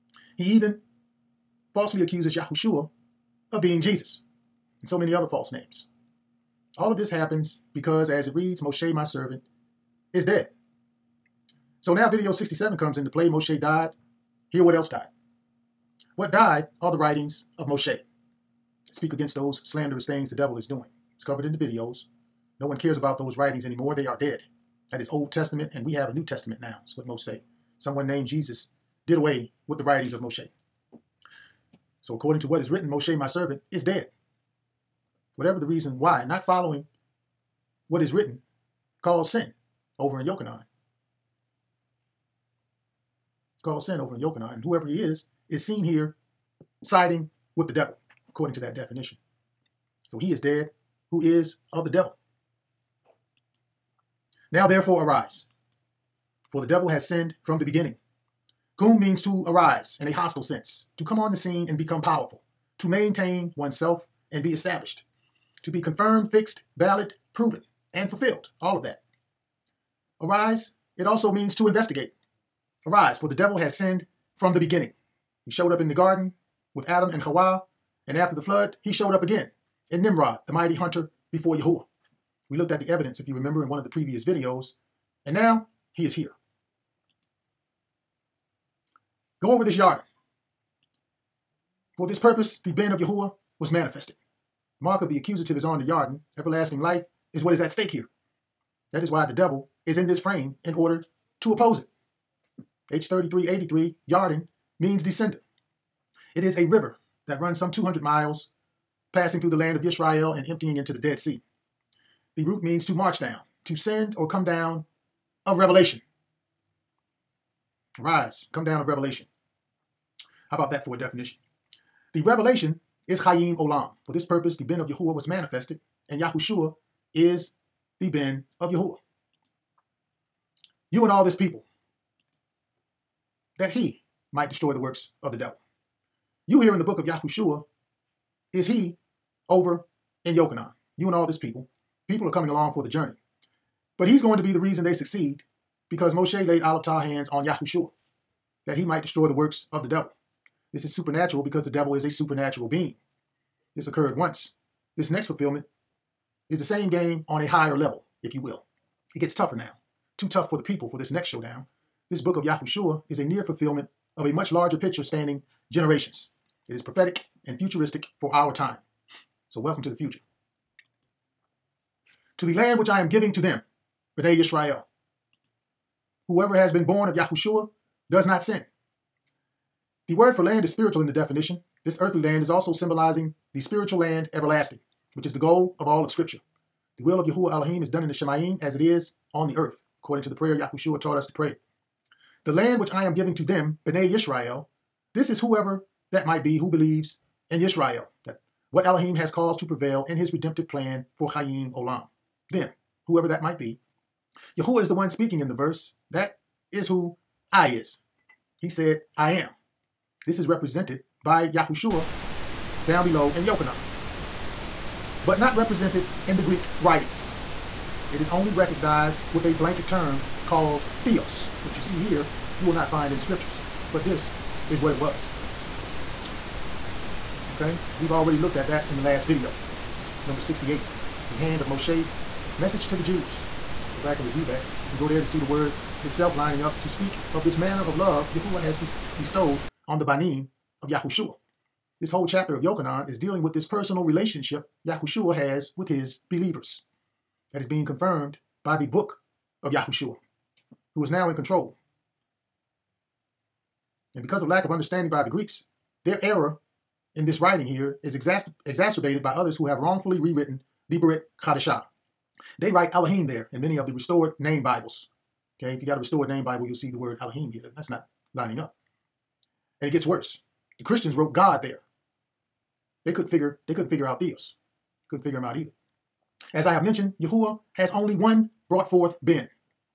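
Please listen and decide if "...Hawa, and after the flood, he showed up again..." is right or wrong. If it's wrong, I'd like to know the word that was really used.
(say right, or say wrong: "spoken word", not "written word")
right.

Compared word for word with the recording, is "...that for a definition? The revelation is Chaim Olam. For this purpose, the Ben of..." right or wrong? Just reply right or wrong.
right.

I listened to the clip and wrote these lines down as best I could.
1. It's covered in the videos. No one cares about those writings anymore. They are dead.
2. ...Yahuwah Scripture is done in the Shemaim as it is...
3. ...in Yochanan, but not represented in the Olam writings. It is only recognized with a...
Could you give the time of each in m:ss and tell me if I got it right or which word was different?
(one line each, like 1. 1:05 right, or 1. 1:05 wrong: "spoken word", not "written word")
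1. 0:21 right
2. 3:07 wrong: "Elohim", not "Scripture"
3. 3:33 wrong: "Greek", not "Olam".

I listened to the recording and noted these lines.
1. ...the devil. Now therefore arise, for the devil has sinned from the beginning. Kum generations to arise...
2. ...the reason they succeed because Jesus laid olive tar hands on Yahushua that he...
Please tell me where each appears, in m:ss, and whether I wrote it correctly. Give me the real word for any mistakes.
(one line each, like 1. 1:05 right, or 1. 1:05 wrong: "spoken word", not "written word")
1. 0:51 wrong: "means", not "generations"
2. 2:24 wrong: "Moshe", not "Jesus".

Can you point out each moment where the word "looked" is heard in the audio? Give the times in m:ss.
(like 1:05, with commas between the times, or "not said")
1:22, 3:48.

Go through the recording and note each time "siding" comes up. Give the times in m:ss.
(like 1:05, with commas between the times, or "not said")
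0:46.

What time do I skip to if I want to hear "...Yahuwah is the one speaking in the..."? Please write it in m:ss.
3:24.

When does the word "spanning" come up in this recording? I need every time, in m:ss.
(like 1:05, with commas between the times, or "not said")
2:45.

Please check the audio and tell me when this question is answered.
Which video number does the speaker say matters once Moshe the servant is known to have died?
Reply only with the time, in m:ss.
0:12.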